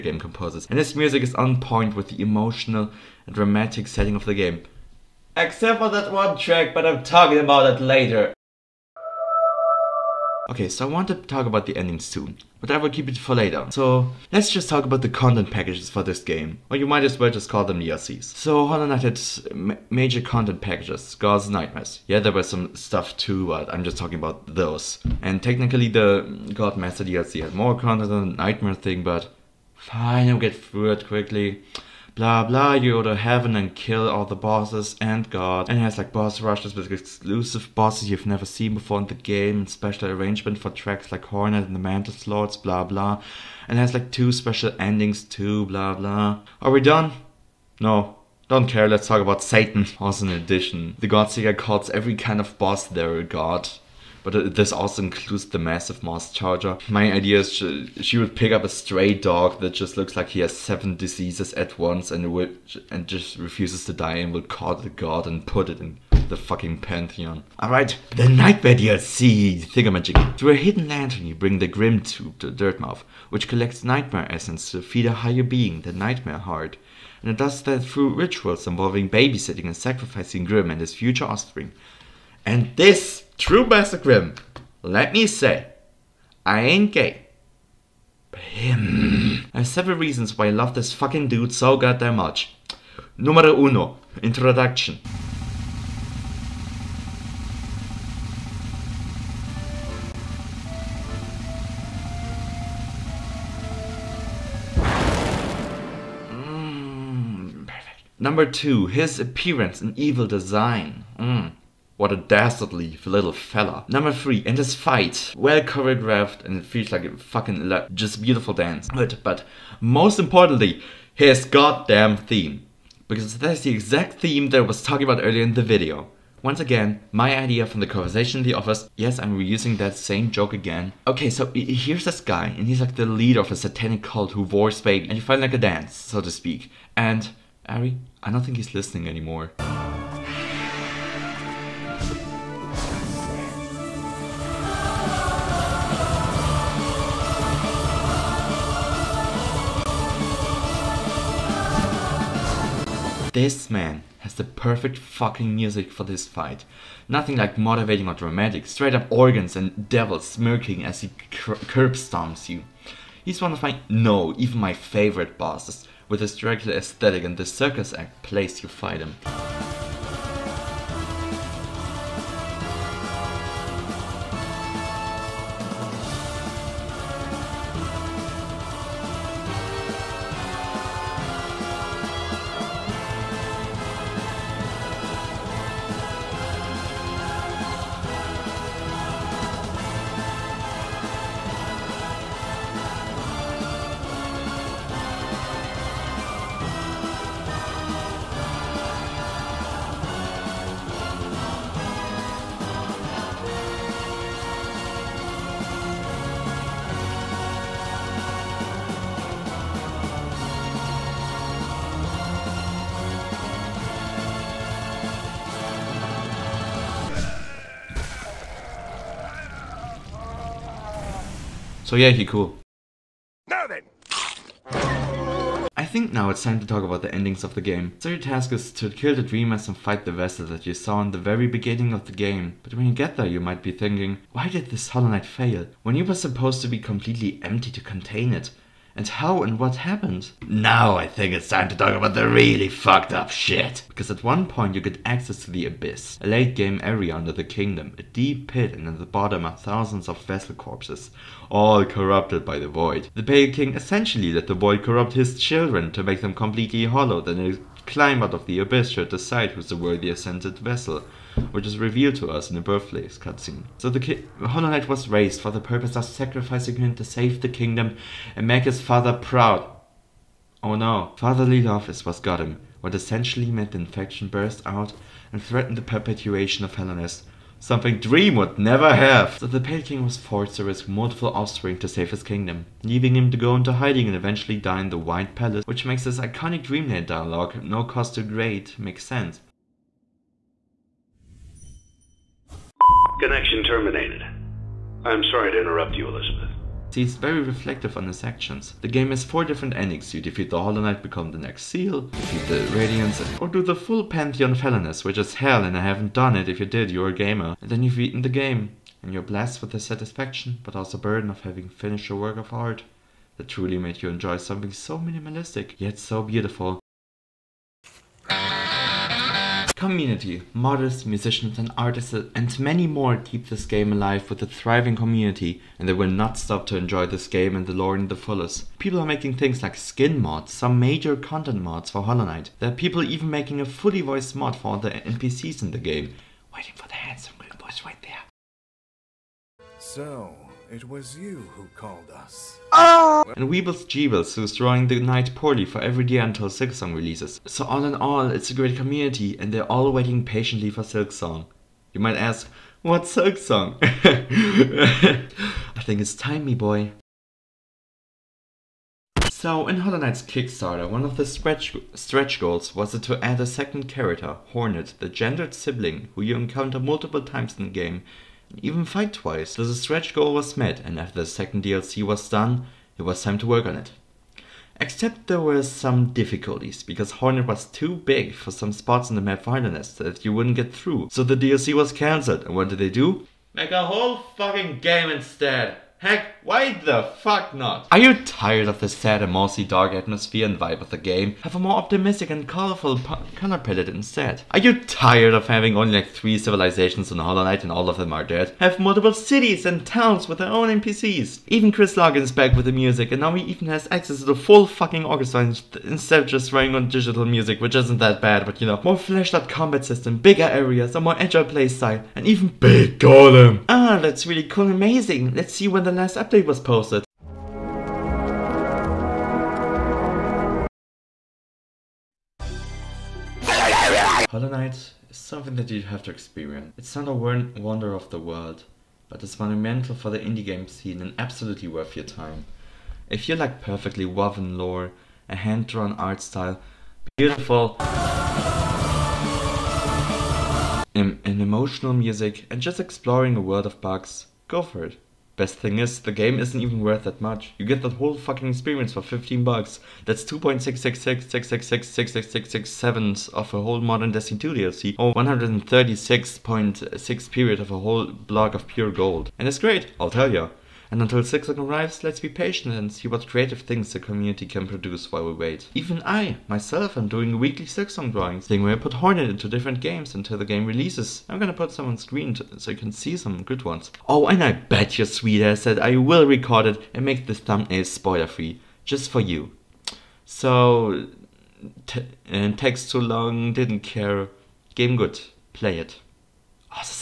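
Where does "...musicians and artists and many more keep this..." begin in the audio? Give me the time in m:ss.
5:21.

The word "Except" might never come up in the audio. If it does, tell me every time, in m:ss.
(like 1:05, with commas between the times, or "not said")
0:05, 6:14.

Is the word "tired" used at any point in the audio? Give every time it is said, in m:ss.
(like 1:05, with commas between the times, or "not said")
6:28, 6:34.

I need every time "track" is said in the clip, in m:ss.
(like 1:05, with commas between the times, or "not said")
0:06, 0:40.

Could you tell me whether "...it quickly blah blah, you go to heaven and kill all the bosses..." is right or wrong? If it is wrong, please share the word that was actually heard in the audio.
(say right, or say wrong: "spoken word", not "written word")
right.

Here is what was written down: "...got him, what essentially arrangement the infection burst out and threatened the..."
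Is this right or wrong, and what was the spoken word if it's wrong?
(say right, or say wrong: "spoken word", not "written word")
wrong: "meant", not "arrangement".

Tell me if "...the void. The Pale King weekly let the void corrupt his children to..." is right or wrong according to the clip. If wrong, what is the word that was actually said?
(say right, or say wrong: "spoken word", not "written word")
wrong: "essentially", not "weekly".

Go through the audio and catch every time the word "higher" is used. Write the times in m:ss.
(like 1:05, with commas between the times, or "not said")
1:15.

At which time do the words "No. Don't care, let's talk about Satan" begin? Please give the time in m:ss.
0:47.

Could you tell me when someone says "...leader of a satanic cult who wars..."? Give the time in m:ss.
2:13.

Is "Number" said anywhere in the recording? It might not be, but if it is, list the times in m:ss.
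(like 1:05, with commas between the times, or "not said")
1:48, 1:53.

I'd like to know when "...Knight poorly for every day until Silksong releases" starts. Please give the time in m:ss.
5:44.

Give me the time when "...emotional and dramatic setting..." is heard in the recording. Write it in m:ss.
0:02.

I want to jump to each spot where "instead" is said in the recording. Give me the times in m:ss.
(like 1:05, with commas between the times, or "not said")
6:25, 6:33, 6:45.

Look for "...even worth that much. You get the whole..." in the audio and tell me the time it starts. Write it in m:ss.
7:26.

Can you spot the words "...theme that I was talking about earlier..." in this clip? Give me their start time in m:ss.
2:04.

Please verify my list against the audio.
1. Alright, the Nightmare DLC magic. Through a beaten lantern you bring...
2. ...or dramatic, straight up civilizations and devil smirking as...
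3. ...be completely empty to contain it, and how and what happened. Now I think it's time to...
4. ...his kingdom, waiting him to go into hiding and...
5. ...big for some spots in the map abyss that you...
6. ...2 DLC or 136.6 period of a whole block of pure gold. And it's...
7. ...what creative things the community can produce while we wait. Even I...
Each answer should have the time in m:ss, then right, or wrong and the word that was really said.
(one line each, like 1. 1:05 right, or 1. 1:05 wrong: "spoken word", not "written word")
1. 1:07 wrong: "hidden", not "beaten"
2. 2:38 wrong: "organs", not "civilizations"
3. 3:56 right
4. 4:42 wrong: "leaving", not "waiting"
5. 6:17 wrong: "wilderness", not "abyss"
6. 7:34 right
7. 7:43 right.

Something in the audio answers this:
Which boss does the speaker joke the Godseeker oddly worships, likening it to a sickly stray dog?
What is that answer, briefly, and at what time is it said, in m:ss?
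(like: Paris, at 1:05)
Massive Moss Charger, at 0:55.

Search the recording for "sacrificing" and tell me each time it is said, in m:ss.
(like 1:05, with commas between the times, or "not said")
1:19, 4:26.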